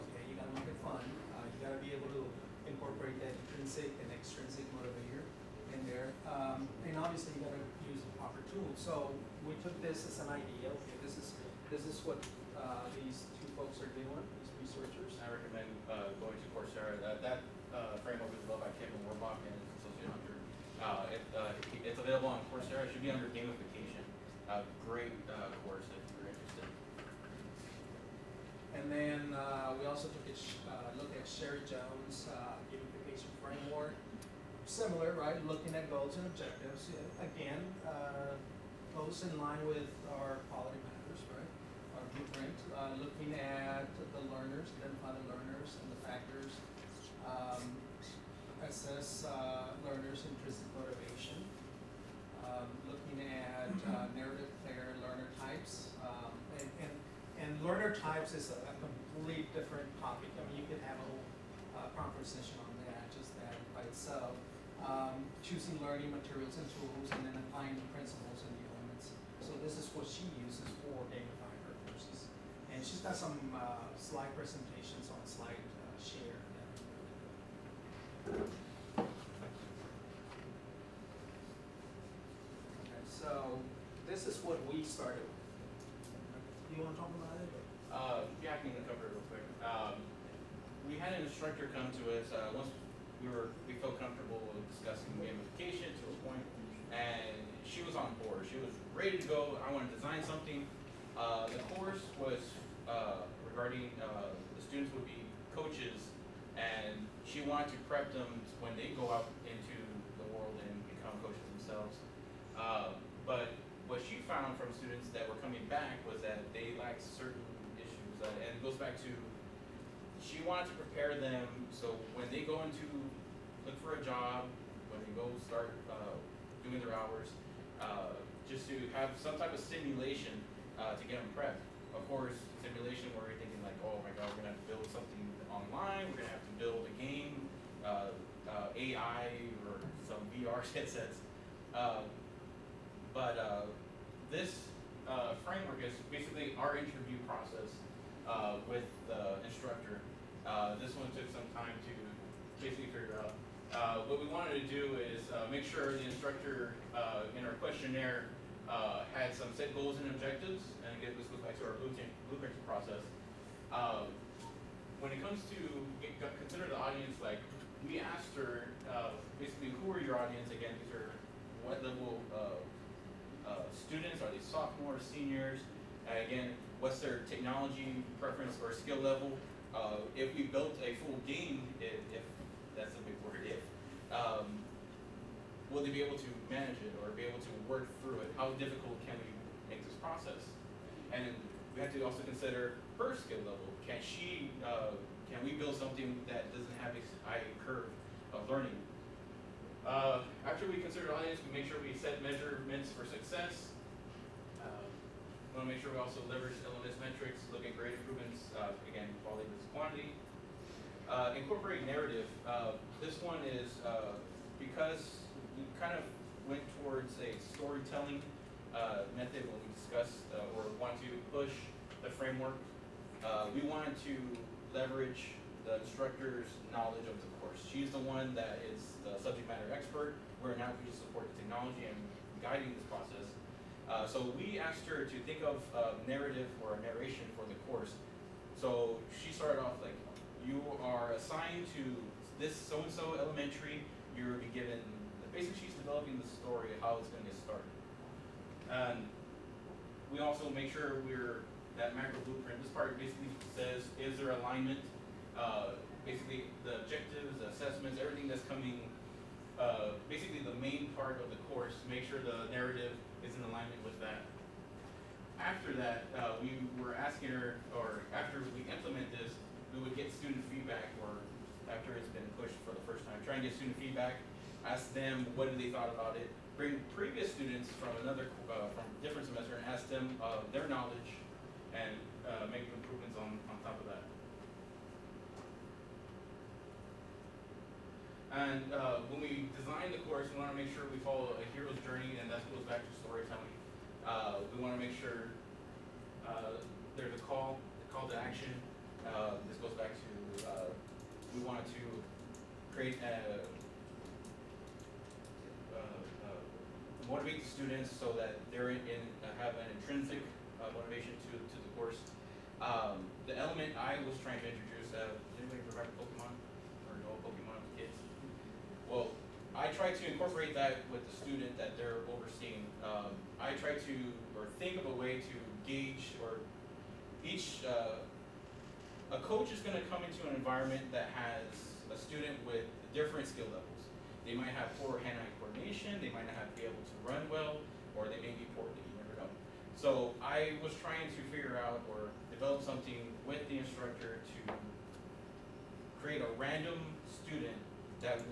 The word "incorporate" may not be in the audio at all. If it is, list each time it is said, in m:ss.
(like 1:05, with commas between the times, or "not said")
0:02, 3:31, 5:20.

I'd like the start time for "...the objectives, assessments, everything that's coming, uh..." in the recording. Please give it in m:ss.
4:16.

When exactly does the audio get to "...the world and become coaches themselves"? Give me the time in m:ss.
1:50.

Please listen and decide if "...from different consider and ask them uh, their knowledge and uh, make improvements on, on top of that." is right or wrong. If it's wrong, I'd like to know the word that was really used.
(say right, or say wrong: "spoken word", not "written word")
wrong: "semester", not "consider".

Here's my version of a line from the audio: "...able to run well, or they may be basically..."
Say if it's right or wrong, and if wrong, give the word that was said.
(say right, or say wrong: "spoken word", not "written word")
wrong: "poorly", not "basically".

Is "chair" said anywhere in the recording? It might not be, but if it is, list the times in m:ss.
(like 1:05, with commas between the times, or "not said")
not said.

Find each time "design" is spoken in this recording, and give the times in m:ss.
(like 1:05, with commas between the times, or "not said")
1:39, 4:49.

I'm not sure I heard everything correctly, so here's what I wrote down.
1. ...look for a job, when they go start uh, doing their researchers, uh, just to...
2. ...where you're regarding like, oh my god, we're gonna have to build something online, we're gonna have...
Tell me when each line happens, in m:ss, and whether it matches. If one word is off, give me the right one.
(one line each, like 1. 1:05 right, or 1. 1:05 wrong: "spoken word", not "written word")
1. 2:03 wrong: "hours", not "researchers"
2. 2:13 wrong: "thinking", not "regarding".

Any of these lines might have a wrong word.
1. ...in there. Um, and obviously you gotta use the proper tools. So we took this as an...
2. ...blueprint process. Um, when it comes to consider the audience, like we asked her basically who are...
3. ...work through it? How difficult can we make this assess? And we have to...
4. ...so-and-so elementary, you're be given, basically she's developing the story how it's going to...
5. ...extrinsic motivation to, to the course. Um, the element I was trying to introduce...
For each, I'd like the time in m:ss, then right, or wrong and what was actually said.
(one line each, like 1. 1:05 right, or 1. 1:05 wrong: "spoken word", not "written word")
1. 0:05 right
2. 2:41 right
3. 3:07 wrong: "process", not "assess"
4. 4:02 right
5. 5:09 wrong: "intrinsic", not "extrinsic".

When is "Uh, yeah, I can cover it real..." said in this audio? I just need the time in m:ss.
1:27.